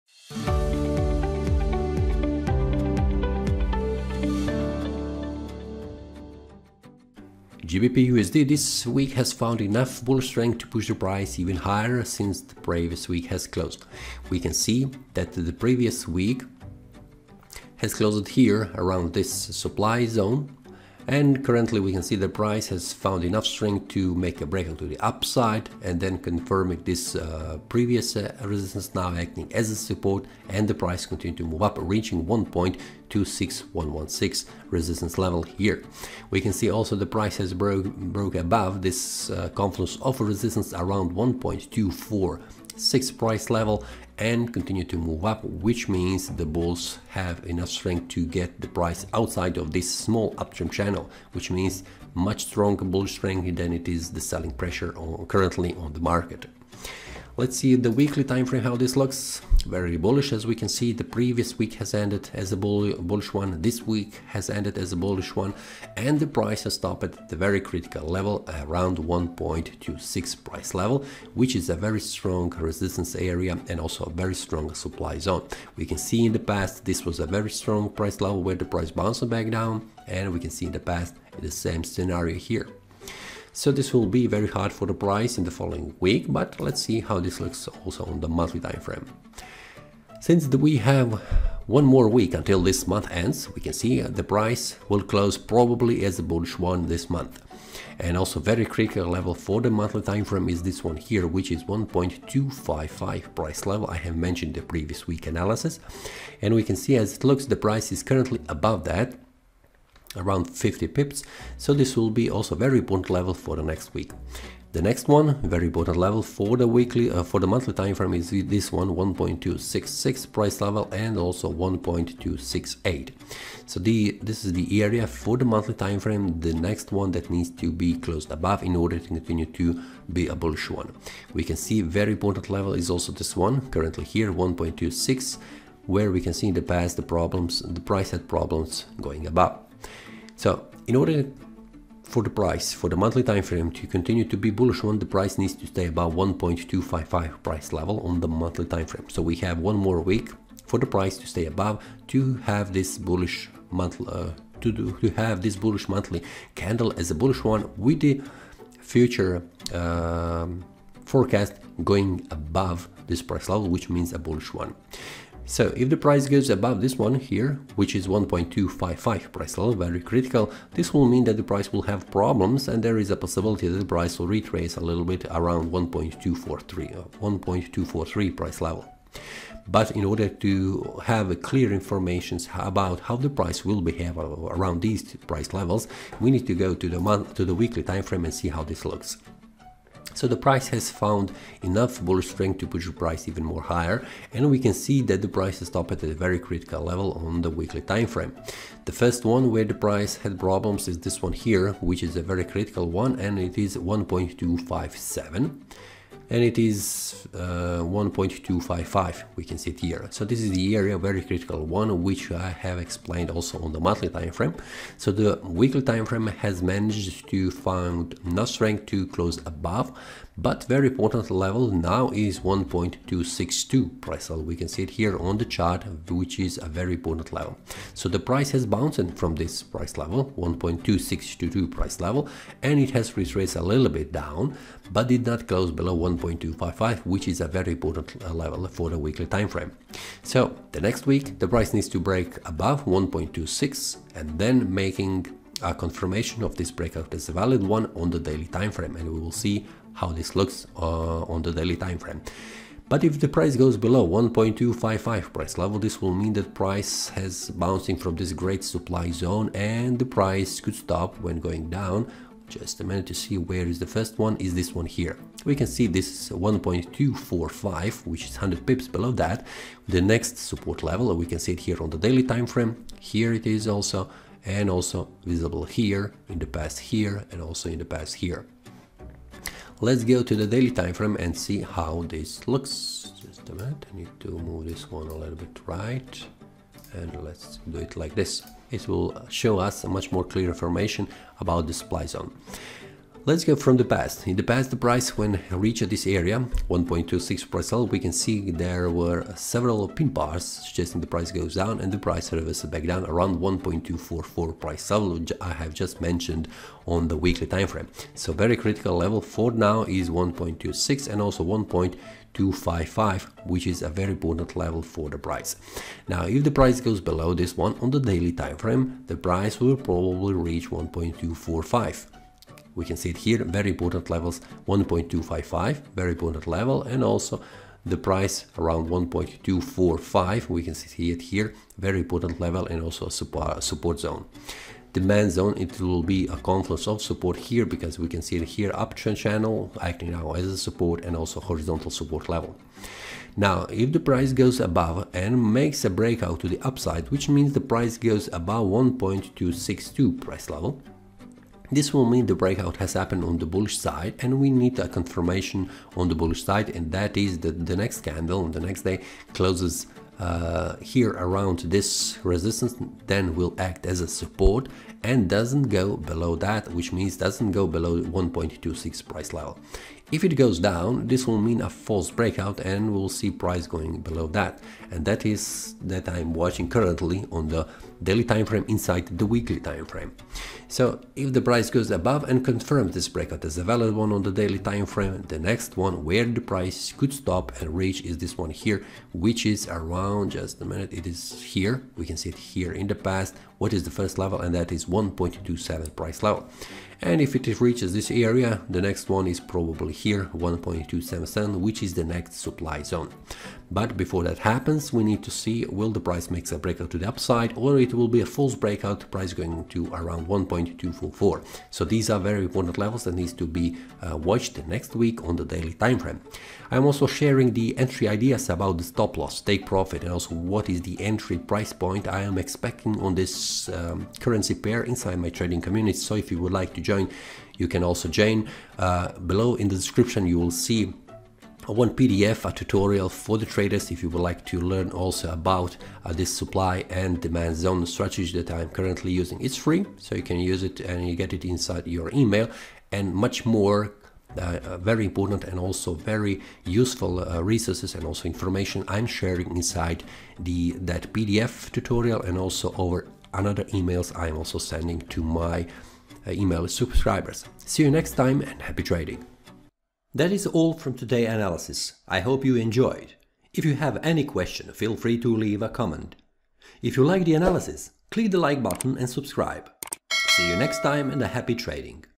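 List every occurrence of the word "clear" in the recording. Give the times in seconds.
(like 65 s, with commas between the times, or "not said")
181 s, 290 s.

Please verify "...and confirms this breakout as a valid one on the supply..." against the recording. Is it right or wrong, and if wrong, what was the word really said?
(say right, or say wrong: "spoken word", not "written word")
wrong: "daily", not "supply".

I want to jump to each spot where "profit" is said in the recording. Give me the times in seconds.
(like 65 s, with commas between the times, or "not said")
419 s.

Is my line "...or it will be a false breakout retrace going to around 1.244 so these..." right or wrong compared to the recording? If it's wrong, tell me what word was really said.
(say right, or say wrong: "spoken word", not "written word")
wrong: "price", not "retrace".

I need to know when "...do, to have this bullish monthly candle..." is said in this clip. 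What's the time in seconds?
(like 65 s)
154 s.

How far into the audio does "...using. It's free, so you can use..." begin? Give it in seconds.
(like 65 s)
439 s.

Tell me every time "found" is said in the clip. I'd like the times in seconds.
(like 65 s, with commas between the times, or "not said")
9 s, 22 s, 190 s.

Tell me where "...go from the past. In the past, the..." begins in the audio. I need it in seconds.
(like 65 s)
293 s.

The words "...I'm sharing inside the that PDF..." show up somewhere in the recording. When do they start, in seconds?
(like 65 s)
448 s.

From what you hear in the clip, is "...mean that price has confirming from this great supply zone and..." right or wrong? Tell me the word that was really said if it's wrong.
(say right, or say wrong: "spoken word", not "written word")
wrong: "bouncing", not "confirming".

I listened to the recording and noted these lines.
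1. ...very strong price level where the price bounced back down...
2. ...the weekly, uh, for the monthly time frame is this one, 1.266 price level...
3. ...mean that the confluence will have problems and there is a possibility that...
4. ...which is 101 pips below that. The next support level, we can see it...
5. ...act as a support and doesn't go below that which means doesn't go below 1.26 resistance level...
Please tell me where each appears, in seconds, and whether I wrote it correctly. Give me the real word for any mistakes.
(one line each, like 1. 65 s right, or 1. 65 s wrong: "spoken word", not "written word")
1. 77 s right
2. 116 s right
3. 171 s wrong: "price", not "confluence"
4. 268 s wrong: "100", not "101"
5. 363 s wrong: "price", not "resistance".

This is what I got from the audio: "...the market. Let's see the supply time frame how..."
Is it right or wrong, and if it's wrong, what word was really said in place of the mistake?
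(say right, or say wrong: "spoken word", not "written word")
wrong: "weekly", not "supply".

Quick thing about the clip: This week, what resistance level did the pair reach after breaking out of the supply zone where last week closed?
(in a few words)
1.26116.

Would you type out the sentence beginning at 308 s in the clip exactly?
So very critical level for now is 1.26 and also 1.255, which is a very important level for the price.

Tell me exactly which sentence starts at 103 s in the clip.
I have mentioned the previous week analysis.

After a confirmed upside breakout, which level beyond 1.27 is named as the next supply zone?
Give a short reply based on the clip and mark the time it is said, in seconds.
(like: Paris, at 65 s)
1.277, at 400 s.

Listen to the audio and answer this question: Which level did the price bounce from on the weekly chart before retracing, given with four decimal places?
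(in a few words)
1.2622.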